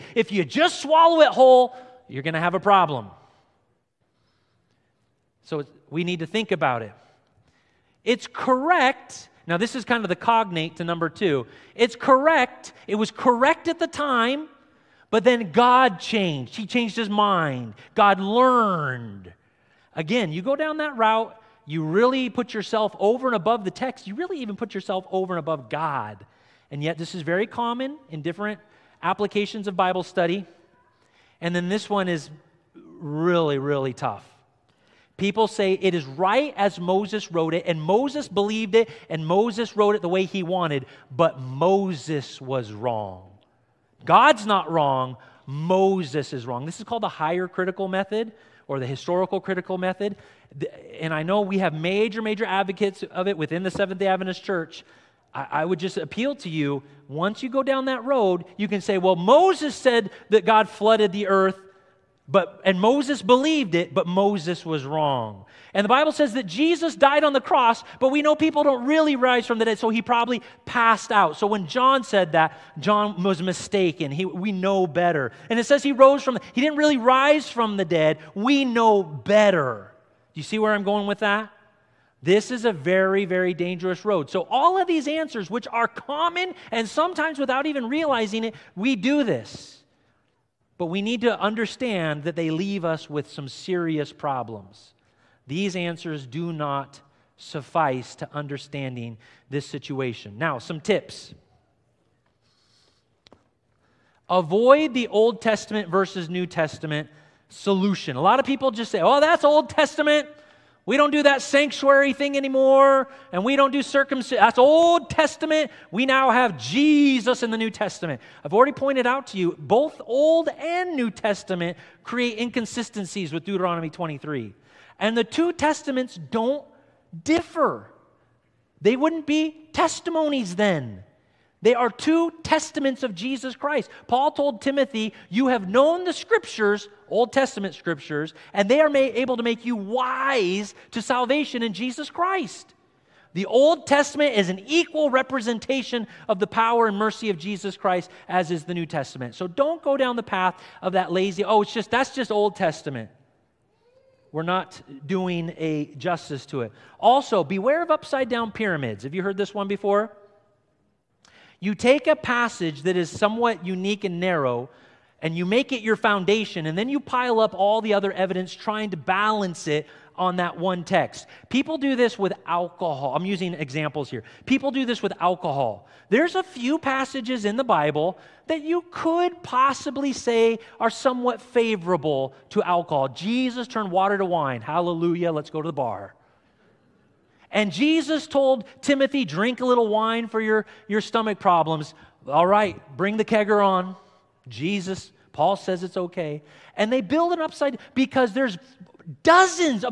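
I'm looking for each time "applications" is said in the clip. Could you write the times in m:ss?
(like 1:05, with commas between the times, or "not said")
0:29.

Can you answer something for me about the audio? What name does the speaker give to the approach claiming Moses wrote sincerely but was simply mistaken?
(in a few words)
Higher critical method.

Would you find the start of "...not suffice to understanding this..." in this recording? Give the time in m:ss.
1:36.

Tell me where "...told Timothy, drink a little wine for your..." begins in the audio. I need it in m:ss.
3:08.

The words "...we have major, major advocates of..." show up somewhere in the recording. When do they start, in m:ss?
0:51.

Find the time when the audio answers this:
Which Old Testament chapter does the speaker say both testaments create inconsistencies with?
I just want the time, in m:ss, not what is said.
2:03.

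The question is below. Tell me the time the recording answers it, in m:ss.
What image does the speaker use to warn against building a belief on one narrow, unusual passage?
2:37.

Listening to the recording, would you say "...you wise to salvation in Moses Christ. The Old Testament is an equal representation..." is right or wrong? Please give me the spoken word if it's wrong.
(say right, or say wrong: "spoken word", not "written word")
wrong: "Jesus", not "Moses".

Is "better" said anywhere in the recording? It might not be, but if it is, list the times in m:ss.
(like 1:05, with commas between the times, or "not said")
1:14, 1:19.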